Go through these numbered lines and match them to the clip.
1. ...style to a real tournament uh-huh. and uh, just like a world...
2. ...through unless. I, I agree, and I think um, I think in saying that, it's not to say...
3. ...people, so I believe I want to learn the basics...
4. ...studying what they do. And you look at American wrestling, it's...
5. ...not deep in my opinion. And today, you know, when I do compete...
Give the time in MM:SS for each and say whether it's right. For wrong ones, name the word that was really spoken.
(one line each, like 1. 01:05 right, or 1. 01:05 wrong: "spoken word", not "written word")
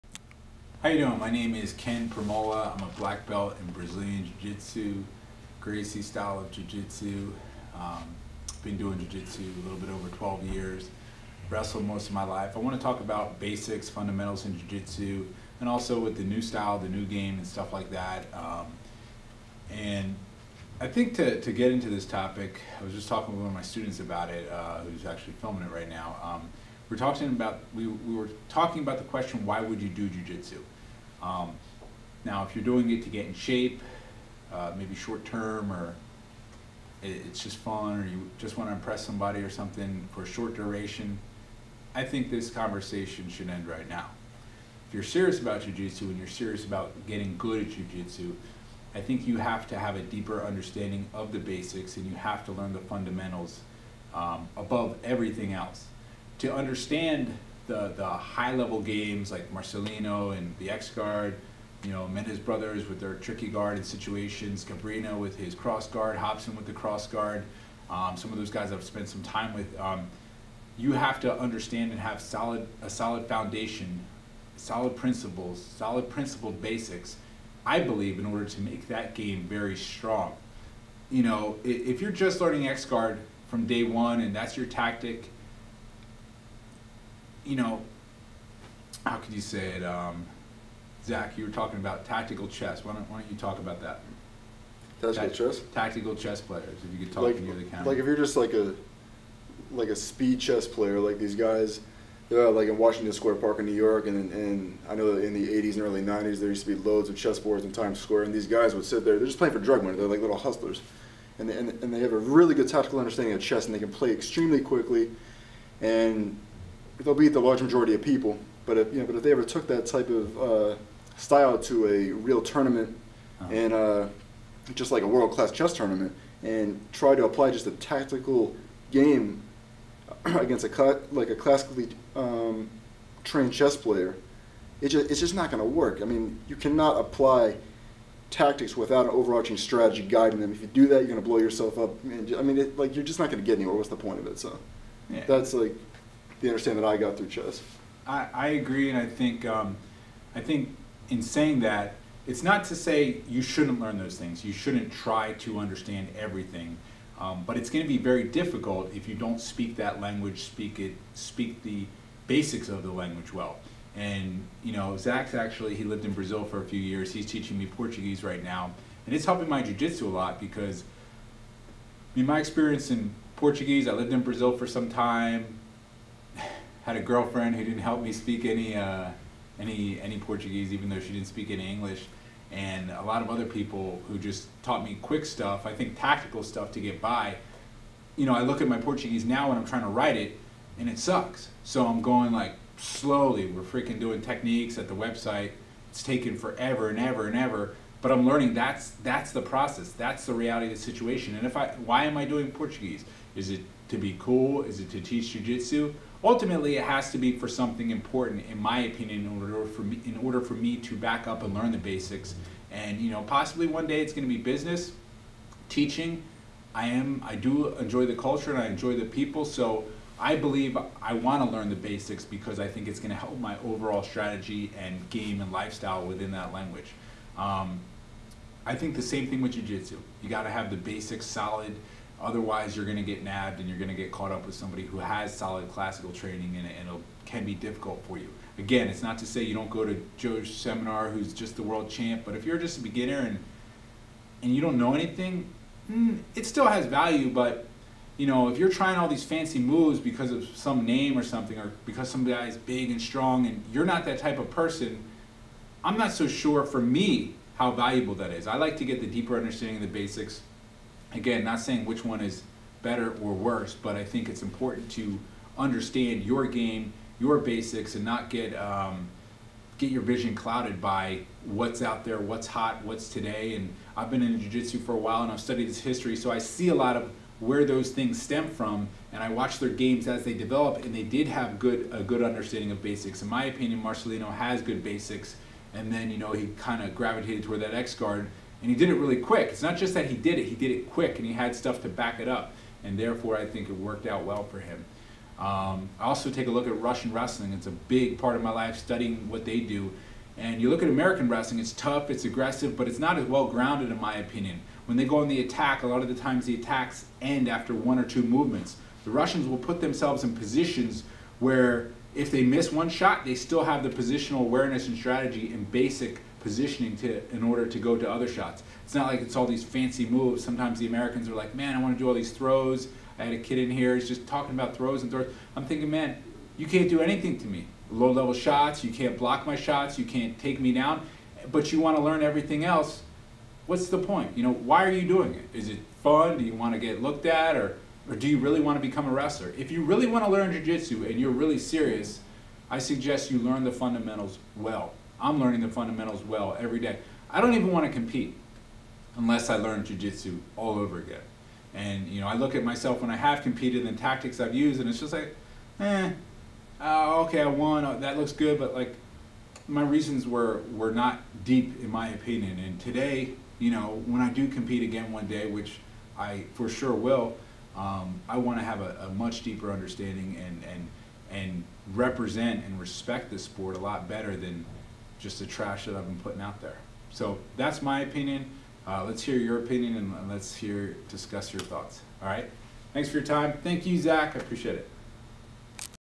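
1. 02:01 right
2. 02:27 wrong: "chess", not "unless"
3. 03:39 right
4. 04:58 right
5. 06:00 right.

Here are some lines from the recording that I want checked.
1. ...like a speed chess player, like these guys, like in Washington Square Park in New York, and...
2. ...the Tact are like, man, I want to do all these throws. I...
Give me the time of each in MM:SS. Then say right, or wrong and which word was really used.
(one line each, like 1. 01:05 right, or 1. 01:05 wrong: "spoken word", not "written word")
1. 01:39 right
2. 05:20 wrong: "Americans", not "Tact".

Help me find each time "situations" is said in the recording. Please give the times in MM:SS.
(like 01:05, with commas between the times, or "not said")
01:03, 03:20.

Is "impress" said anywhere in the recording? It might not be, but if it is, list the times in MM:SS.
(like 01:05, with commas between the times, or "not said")
00:38.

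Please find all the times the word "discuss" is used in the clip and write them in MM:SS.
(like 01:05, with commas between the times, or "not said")
06:21.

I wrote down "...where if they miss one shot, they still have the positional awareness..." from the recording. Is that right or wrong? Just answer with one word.
right.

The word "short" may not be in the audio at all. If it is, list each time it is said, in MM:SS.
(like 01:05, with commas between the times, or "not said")
00:34, 00:40.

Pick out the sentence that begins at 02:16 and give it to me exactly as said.
I mean, you cannot apply tactics without an overarching strategy guiding them.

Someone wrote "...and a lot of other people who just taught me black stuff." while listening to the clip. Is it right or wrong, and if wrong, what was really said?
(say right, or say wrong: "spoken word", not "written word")
wrong: "quick", not "black".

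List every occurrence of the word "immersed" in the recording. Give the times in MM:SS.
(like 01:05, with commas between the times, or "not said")
not said.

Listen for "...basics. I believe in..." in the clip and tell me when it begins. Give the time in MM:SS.
01:16.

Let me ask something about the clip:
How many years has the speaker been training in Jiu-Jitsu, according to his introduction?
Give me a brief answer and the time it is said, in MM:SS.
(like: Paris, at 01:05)
12, at 00:10.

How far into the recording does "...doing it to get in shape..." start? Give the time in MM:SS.
00:32.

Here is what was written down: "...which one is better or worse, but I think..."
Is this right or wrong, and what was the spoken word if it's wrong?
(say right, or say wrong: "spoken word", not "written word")
right.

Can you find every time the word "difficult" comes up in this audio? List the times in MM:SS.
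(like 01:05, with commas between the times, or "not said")
02:38, 03:57.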